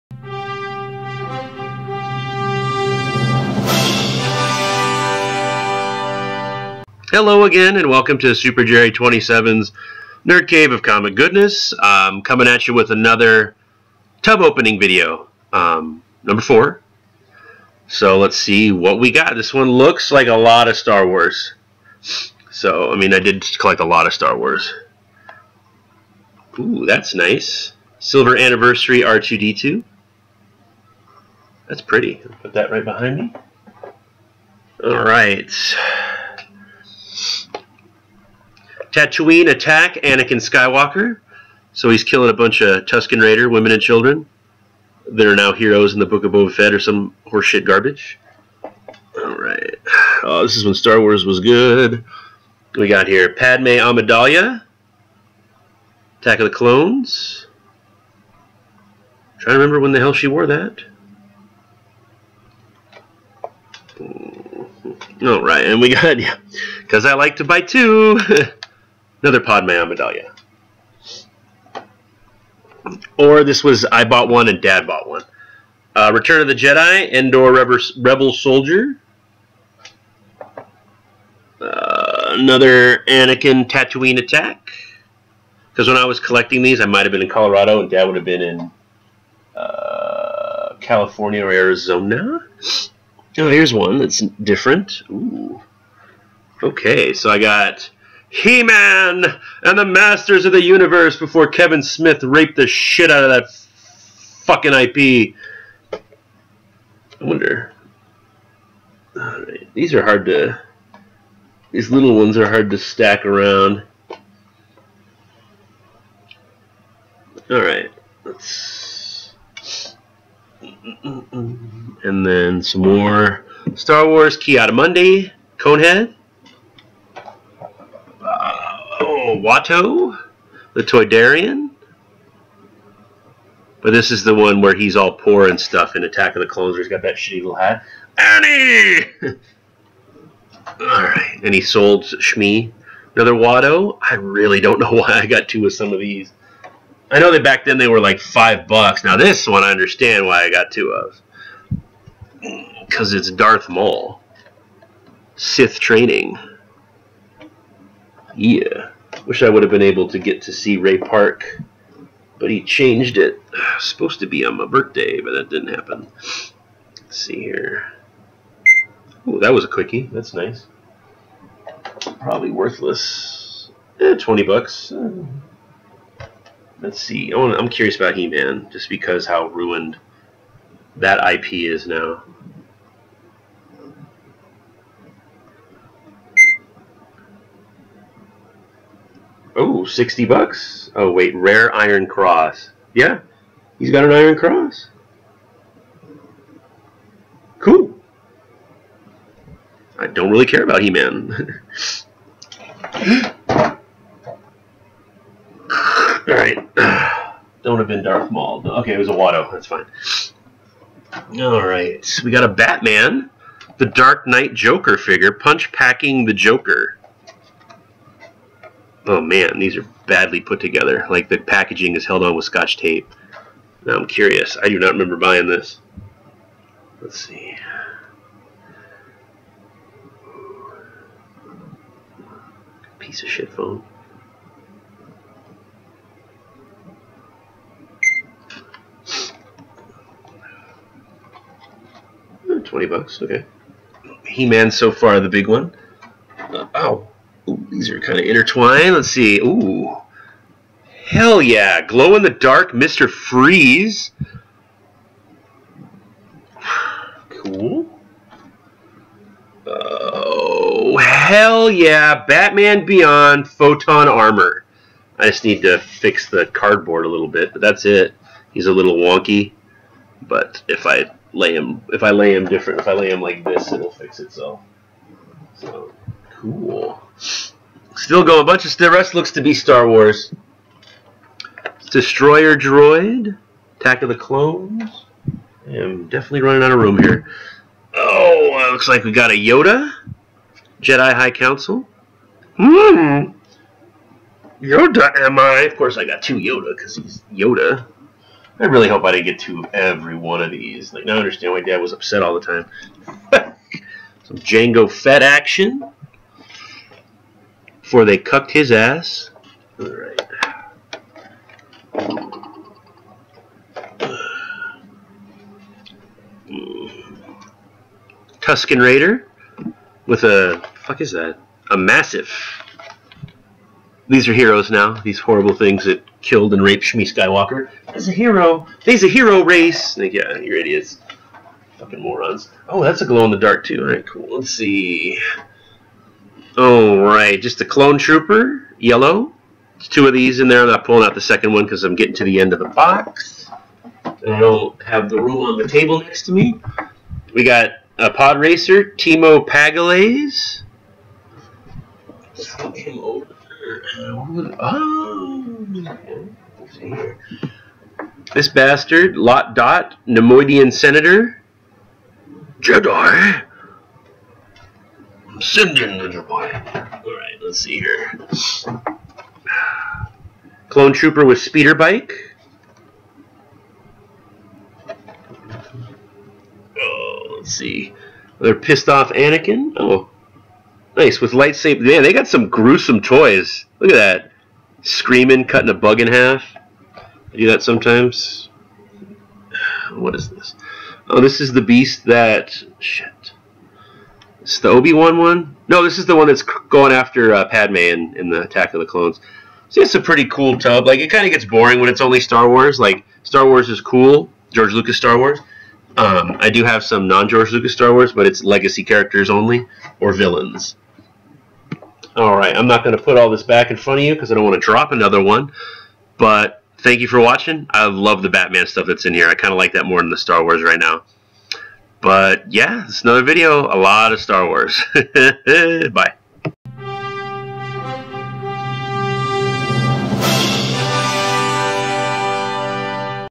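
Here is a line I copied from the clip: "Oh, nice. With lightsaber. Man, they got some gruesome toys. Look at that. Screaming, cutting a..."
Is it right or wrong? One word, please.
right.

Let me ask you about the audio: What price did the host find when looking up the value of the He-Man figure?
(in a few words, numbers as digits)
60 dollars.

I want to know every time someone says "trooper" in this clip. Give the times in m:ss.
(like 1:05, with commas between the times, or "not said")
5:37, 6:10.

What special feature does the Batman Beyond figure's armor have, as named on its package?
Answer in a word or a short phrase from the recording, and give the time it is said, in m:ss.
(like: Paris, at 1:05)
Photon Armor, at 4:23.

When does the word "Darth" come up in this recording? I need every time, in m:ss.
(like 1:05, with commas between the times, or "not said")
2:33, 3:28.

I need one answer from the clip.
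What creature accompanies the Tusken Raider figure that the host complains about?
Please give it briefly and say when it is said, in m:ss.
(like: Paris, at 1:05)
Massiff, at 5:21.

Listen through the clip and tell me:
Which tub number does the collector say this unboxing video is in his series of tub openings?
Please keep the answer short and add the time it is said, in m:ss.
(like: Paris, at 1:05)
4, at 0:16.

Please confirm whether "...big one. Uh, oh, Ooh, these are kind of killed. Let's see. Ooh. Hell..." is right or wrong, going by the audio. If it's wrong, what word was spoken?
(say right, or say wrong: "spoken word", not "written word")
wrong: "intertwined", not "killed".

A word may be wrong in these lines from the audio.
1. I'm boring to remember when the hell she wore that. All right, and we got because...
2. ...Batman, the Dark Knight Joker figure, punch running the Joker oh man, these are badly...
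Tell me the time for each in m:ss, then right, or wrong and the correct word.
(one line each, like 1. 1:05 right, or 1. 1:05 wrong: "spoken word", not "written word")
1. 0:59 wrong: "trying", not "boring"
2. 3:32 wrong: "packing", not "running".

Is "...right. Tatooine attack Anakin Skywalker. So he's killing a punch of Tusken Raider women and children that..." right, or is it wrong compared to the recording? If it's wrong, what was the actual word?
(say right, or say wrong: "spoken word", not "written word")
wrong: "bunch", not "punch".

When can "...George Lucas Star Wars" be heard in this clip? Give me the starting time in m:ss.
6:44.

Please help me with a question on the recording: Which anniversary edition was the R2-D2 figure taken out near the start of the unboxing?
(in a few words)
Silver Anniversary.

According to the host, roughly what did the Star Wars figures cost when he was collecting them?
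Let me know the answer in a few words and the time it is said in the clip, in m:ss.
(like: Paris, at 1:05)
5 dollars, at 2:28.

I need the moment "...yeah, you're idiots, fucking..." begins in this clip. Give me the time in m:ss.
5:30.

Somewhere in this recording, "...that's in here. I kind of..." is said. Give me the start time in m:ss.
6:58.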